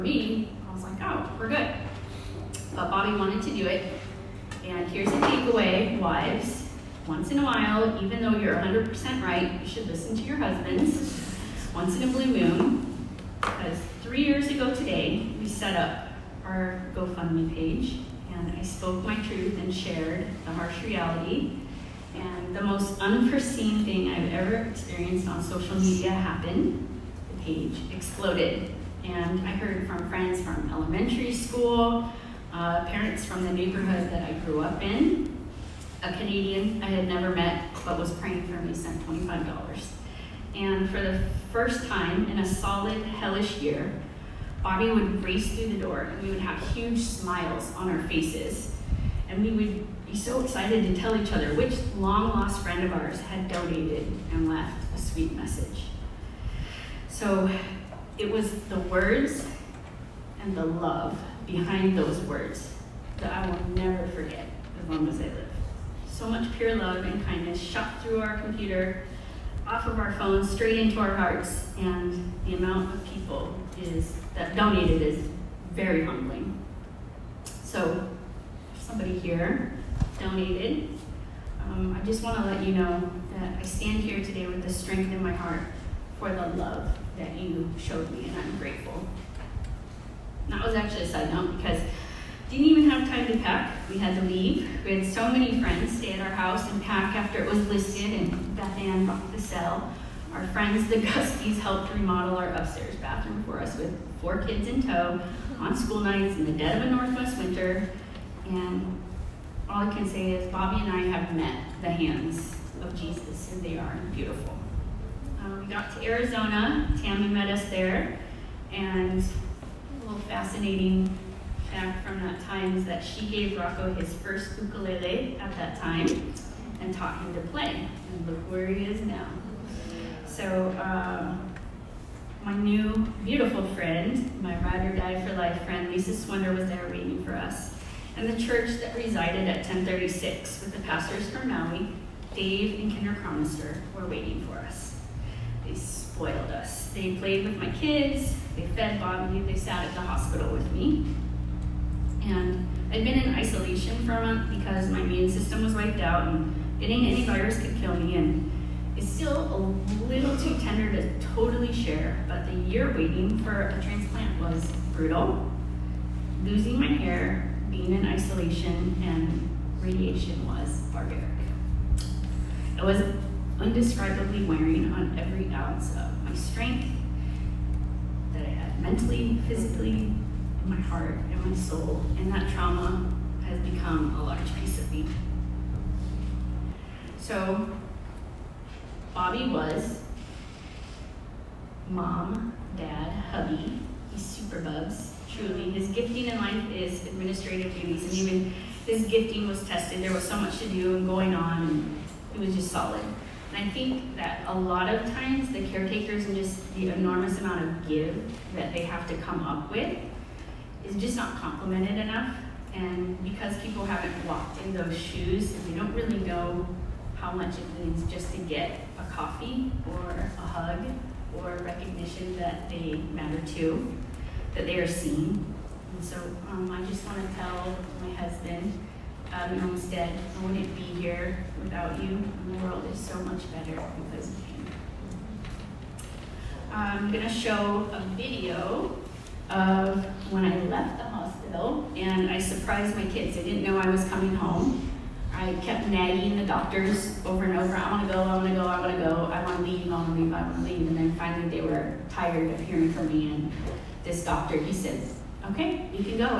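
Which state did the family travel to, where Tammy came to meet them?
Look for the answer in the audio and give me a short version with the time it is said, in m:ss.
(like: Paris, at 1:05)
Arizona, at 1:56.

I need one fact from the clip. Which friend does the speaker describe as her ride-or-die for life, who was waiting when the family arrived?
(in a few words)
Lisa Swender.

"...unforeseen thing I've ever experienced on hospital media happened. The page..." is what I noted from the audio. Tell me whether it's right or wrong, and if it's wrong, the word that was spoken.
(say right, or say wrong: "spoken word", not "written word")
wrong: "social", not "hospital".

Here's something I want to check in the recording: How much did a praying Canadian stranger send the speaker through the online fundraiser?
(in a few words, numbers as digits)
$25.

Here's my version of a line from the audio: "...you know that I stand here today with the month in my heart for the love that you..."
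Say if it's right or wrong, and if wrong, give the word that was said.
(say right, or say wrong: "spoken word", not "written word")
wrong: "strength", not "month".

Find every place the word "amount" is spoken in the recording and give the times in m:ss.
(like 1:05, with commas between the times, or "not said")
1:12, 3:27.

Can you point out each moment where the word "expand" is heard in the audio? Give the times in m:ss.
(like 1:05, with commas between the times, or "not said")
not said.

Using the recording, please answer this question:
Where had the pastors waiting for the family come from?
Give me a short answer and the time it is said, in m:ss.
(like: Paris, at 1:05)
Maui, at 2:21.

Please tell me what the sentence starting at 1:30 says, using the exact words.
And that was actually a side note because didn't even have time to pack.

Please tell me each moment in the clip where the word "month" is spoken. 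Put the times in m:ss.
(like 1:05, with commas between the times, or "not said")
2:34.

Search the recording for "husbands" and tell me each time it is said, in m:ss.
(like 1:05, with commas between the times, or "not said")
0:10, 3:48.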